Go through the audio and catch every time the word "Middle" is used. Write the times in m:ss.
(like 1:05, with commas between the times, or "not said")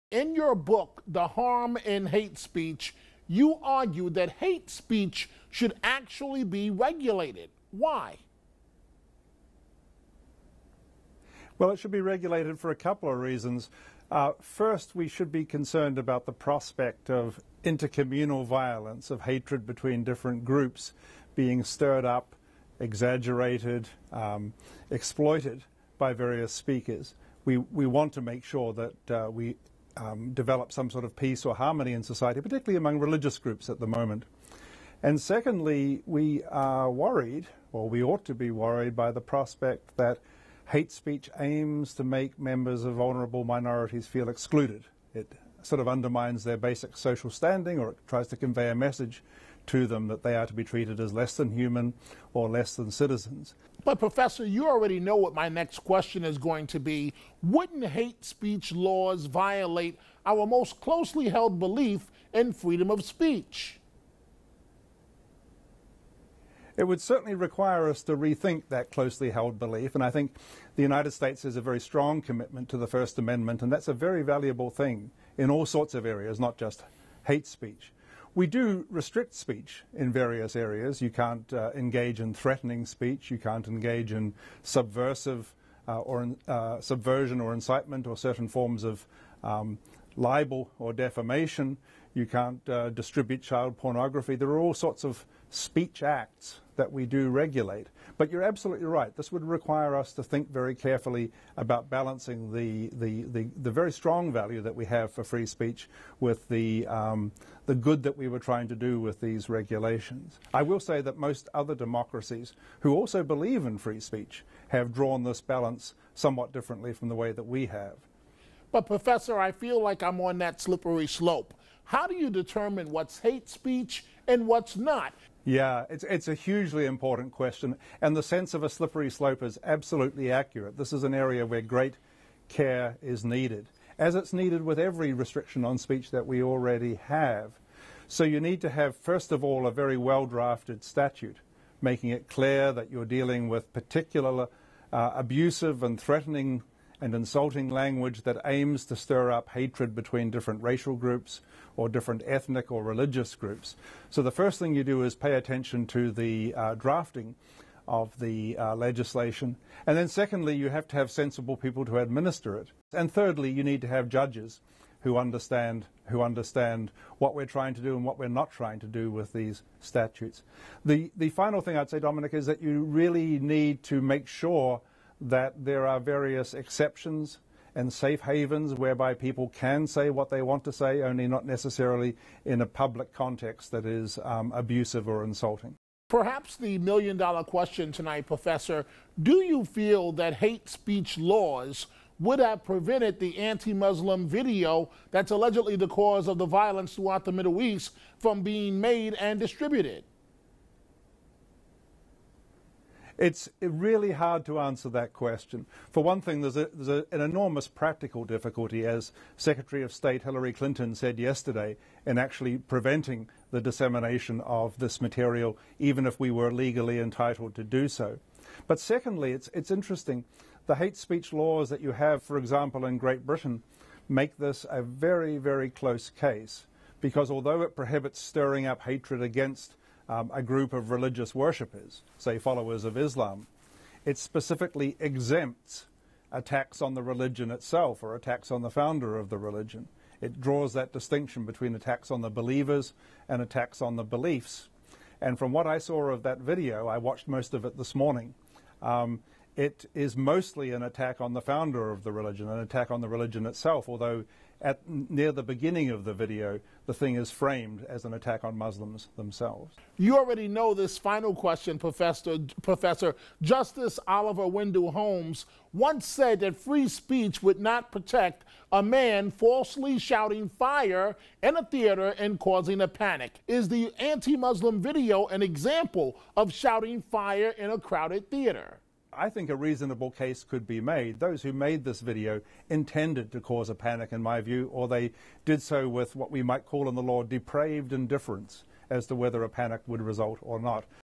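3:17.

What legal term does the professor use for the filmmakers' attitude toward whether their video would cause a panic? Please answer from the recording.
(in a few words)
depraved indifference.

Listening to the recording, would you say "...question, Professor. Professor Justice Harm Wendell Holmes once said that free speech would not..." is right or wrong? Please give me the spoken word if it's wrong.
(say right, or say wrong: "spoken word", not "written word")
wrong: "Oliver", not "Harm".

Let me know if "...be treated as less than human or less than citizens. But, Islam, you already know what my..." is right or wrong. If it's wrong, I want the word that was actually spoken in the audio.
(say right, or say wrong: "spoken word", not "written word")
wrong: "Professor", not "Islam".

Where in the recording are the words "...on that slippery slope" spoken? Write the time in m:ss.
2:00.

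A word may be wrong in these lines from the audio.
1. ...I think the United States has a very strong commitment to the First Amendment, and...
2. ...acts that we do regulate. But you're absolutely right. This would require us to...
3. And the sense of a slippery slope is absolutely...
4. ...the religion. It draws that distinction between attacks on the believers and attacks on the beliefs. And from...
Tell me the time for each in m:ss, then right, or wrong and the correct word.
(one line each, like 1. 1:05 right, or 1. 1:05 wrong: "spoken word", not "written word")
1. 1:10 right
2. 1:36 right
3. 2:08 right
4. 3:59 right.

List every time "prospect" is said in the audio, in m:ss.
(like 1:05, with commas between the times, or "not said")
0:16, 0:39.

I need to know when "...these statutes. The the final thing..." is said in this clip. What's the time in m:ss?
2:49.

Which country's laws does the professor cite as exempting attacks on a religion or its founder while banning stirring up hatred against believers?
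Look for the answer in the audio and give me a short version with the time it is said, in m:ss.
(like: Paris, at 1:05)
Great Britain, at 3:42.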